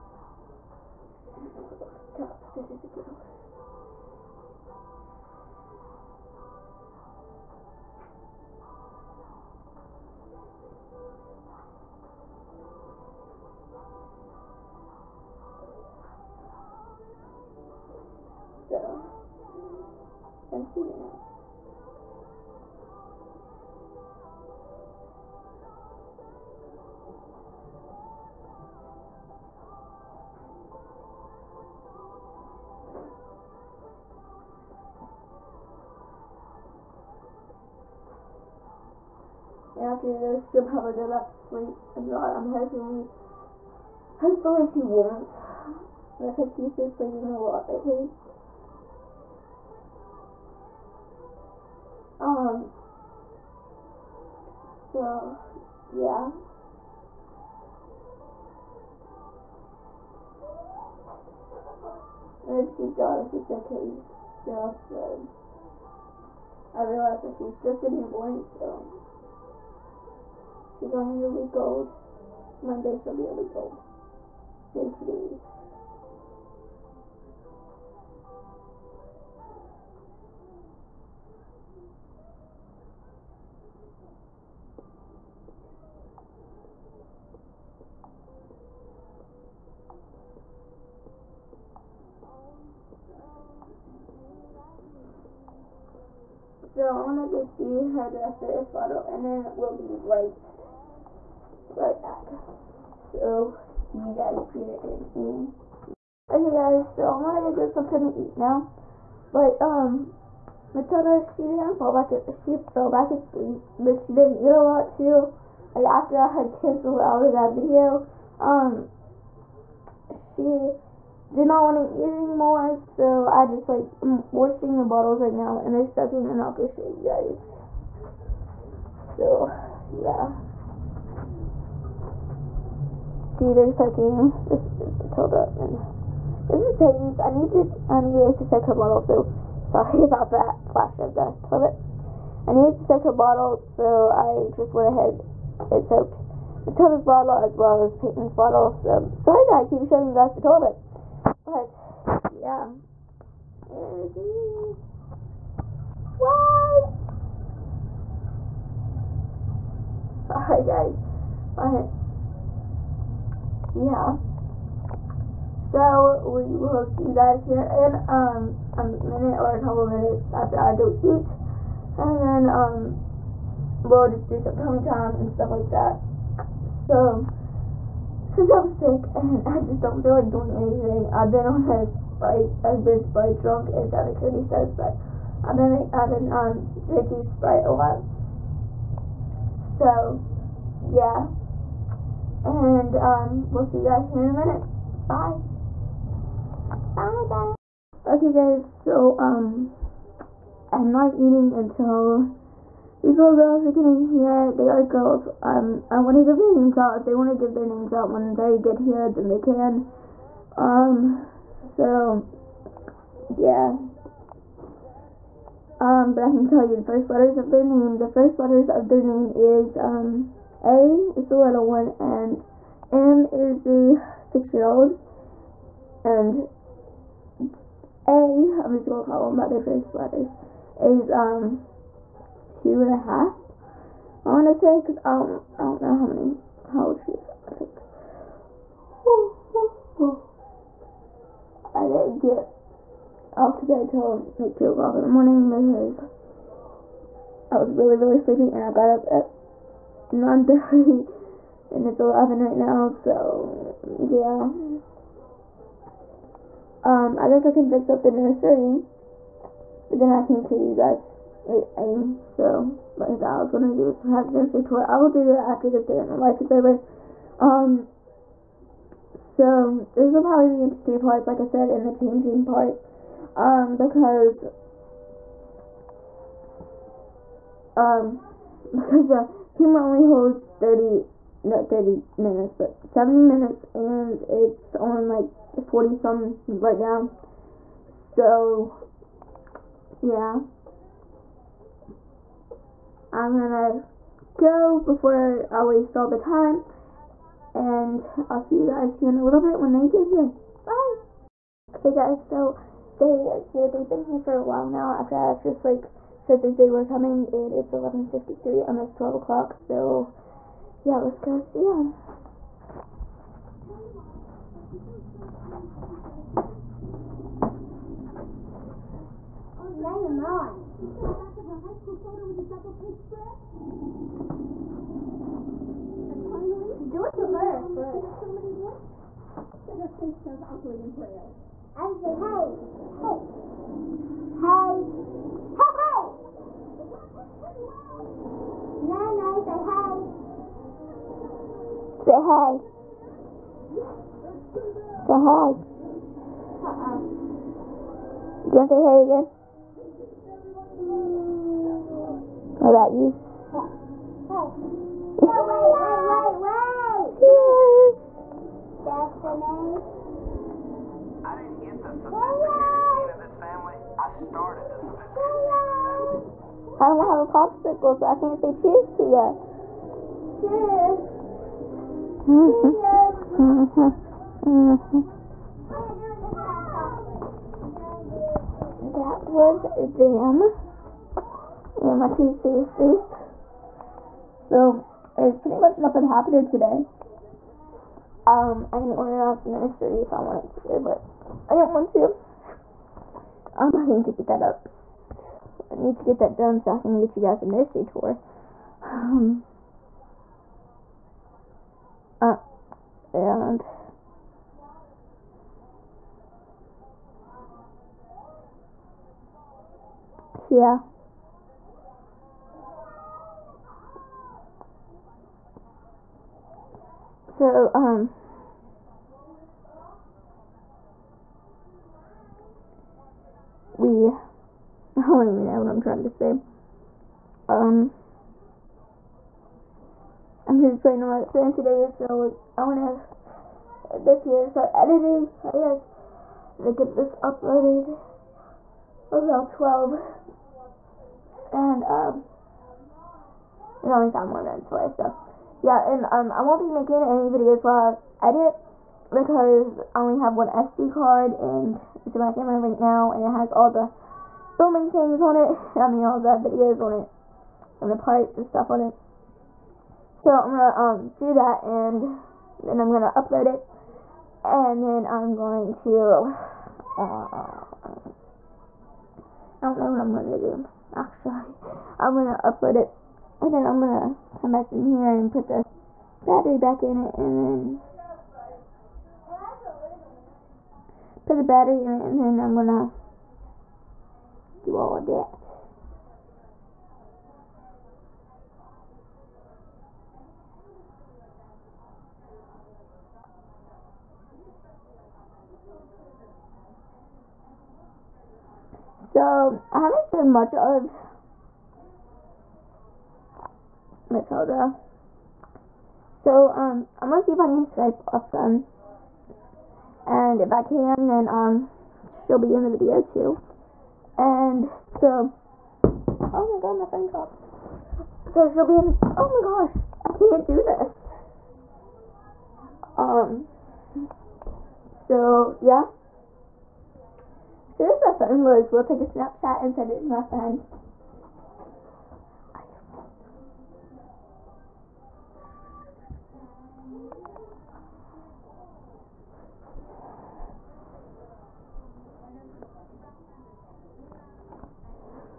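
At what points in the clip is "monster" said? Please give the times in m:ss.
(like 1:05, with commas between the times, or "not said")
not said.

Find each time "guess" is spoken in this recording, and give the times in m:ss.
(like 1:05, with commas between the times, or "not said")
4:17, 7:15.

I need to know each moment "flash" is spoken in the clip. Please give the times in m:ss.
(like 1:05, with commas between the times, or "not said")
2:20.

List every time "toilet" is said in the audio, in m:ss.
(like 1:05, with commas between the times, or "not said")
2:21, 2:30.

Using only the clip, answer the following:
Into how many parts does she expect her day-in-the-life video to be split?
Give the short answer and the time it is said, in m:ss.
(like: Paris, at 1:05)
3, at 4:30.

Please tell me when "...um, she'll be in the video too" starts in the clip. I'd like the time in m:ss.
8:31.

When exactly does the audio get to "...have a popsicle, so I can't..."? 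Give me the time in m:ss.
6:07.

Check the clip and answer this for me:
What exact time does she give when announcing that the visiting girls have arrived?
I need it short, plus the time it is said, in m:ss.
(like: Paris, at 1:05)
11:53, at 5:07.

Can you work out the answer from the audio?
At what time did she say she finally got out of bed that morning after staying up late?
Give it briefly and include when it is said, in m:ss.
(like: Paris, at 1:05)
9:30, at 4:10.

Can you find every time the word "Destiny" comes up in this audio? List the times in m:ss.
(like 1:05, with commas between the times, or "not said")
5:58.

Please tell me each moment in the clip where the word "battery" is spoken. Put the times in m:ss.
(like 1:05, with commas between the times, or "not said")
7:56, 8:01.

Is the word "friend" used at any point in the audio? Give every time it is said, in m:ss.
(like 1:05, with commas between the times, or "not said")
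8:28, 8:50.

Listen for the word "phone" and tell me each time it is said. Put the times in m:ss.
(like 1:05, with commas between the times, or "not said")
7:11, 8:36, 8:48.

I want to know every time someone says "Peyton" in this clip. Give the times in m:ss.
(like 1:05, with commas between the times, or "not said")
2:16, 2:27.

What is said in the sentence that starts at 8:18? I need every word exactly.
So, I haven't shown much of Matilda.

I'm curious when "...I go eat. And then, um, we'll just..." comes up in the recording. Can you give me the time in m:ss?
2:50.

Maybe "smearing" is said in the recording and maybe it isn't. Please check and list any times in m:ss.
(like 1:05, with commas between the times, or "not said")
not said.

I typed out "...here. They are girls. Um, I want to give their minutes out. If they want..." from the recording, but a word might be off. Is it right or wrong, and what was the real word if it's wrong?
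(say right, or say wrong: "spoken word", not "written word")
wrong: "names", not "minutes".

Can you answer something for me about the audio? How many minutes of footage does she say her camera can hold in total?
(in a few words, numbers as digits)
70.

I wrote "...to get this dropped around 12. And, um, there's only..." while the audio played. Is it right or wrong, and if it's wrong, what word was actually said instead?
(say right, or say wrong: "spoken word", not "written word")
wrong: "uploaded", not "dropped".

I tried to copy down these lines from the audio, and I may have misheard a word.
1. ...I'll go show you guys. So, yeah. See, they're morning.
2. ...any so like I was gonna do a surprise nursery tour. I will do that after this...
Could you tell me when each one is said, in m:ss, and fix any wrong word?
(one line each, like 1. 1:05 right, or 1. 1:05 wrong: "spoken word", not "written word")
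1. 2:06 wrong: "soaking", not "morning"
2. 4:21 right.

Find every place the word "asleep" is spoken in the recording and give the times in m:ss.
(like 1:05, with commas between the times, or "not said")
1:53.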